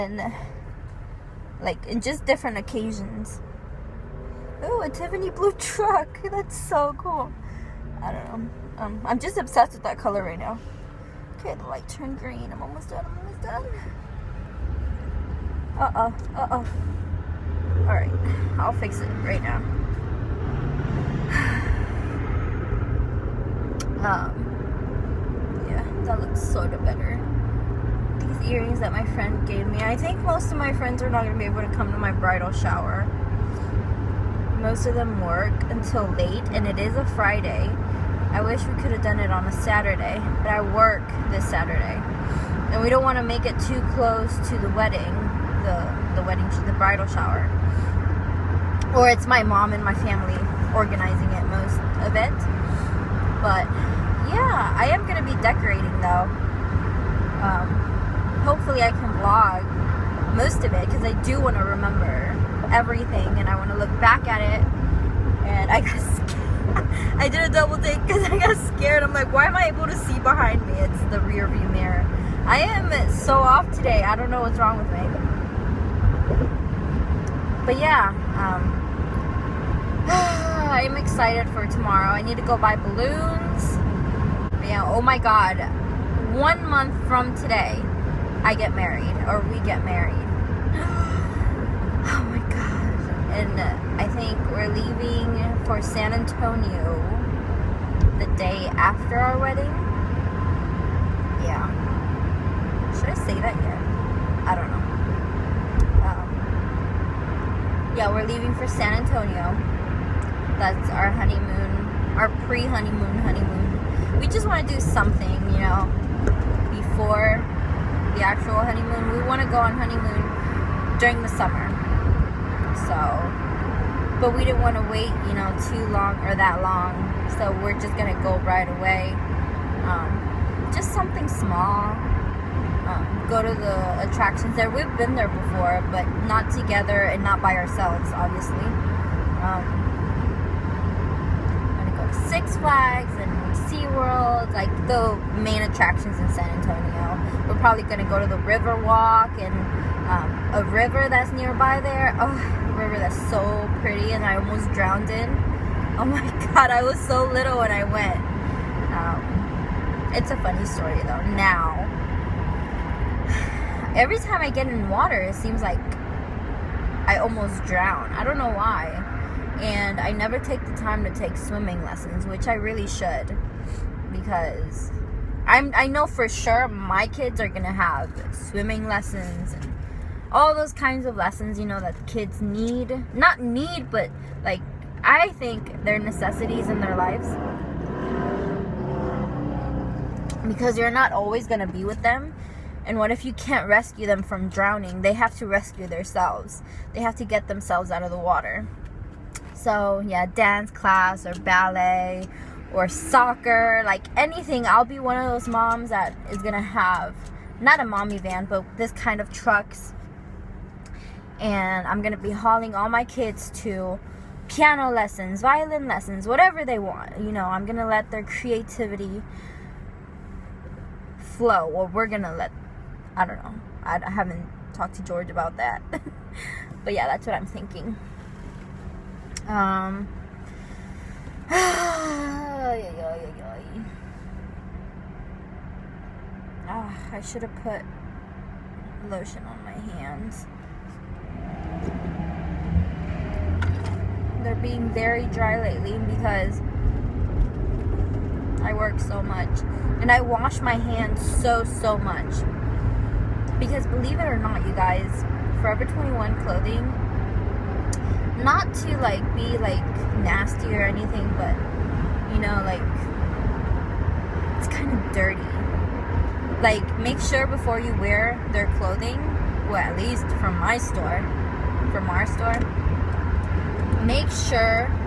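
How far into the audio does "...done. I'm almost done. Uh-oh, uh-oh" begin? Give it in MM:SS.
00:12.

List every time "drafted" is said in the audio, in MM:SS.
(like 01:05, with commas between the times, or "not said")
not said.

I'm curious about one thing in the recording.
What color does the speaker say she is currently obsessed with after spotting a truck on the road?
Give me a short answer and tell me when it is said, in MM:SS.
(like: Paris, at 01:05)
Tiffany blue, at 00:04.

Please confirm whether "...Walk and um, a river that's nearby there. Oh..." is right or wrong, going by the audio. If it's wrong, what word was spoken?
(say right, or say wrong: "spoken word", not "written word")
right.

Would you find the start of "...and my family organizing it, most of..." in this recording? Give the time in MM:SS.
00:49.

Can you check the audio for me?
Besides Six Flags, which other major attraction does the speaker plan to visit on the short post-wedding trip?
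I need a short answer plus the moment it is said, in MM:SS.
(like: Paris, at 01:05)
SeaWorld, at 02:23.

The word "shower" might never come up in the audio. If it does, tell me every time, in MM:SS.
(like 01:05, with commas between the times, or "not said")
00:32, 00:47.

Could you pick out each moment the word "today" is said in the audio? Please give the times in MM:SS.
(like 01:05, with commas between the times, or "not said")
01:13, 01:27.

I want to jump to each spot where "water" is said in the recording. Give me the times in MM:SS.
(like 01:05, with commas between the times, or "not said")
02:44, 03:18.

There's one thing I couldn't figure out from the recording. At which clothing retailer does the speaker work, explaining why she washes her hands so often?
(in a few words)
Forever 21.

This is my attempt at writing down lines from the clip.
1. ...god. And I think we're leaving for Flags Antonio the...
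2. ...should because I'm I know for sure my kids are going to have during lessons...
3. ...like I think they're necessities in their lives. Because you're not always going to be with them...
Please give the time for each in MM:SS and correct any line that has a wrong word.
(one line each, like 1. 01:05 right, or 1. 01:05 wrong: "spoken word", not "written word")
1. 01:32 wrong: "San", not "Flags"
2. 02:52 wrong: "swimming", not "during"
3. 03:04 right.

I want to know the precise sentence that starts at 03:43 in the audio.
I, I haven't talked to George about that.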